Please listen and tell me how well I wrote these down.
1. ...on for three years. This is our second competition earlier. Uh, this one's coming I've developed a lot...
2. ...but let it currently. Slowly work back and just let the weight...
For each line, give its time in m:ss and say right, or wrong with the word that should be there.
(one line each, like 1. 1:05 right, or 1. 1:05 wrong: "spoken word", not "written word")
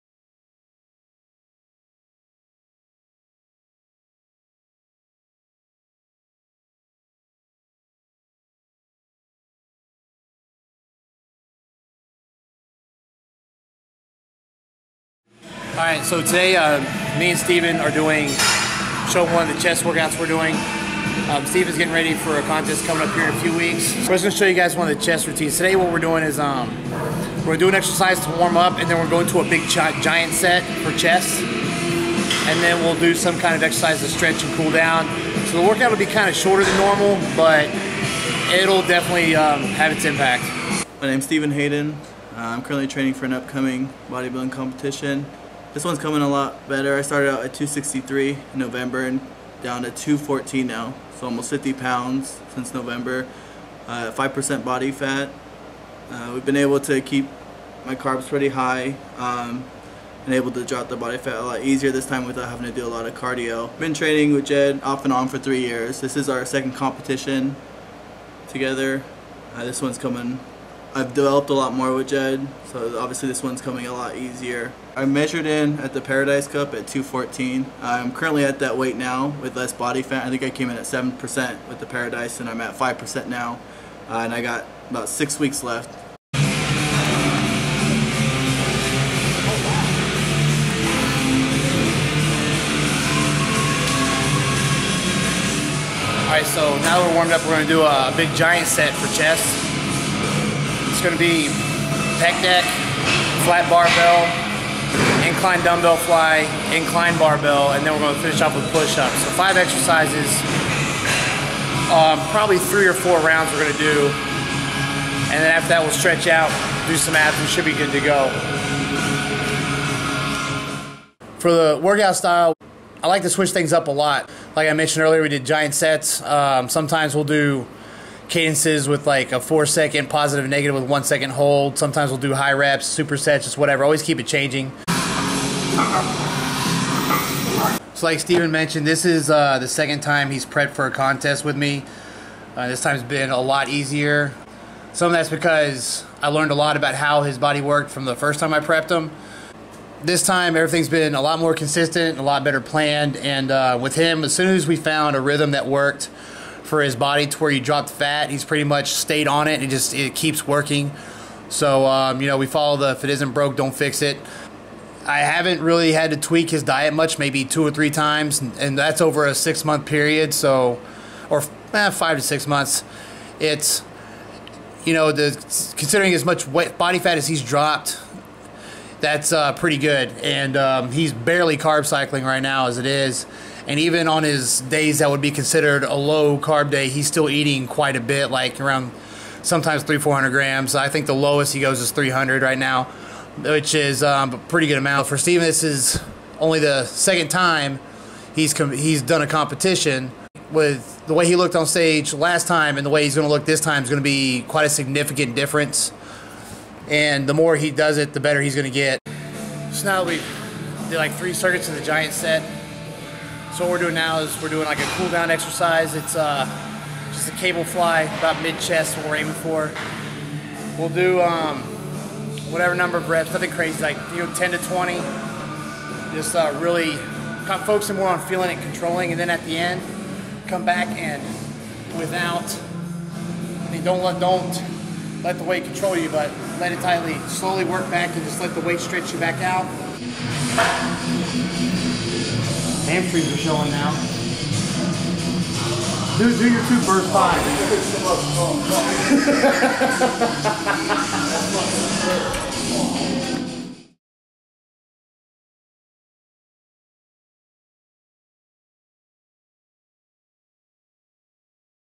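1. 1:05 wrong: "together", not "earlier"
2. 3:56 wrong: "tightly", not "currently".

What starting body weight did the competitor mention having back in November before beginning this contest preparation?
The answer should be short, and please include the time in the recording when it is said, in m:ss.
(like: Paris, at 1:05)
263, at 0:47.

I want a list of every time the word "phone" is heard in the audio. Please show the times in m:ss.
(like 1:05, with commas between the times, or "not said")
not said.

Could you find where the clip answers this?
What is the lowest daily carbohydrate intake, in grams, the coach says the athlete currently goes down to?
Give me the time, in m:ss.
3:11.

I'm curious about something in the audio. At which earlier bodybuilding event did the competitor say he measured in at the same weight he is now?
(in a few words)
Paradise Cup.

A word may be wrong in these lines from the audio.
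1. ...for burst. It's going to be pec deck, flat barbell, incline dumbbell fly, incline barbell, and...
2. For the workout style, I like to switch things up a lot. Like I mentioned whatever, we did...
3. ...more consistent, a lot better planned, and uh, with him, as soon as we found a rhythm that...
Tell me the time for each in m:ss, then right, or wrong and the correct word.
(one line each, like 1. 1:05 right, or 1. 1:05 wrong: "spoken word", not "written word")
1. 1:38 wrong: "chest", not "burst"
2. 2:01 wrong: "earlier", not "whatever"
3. 2:31 right.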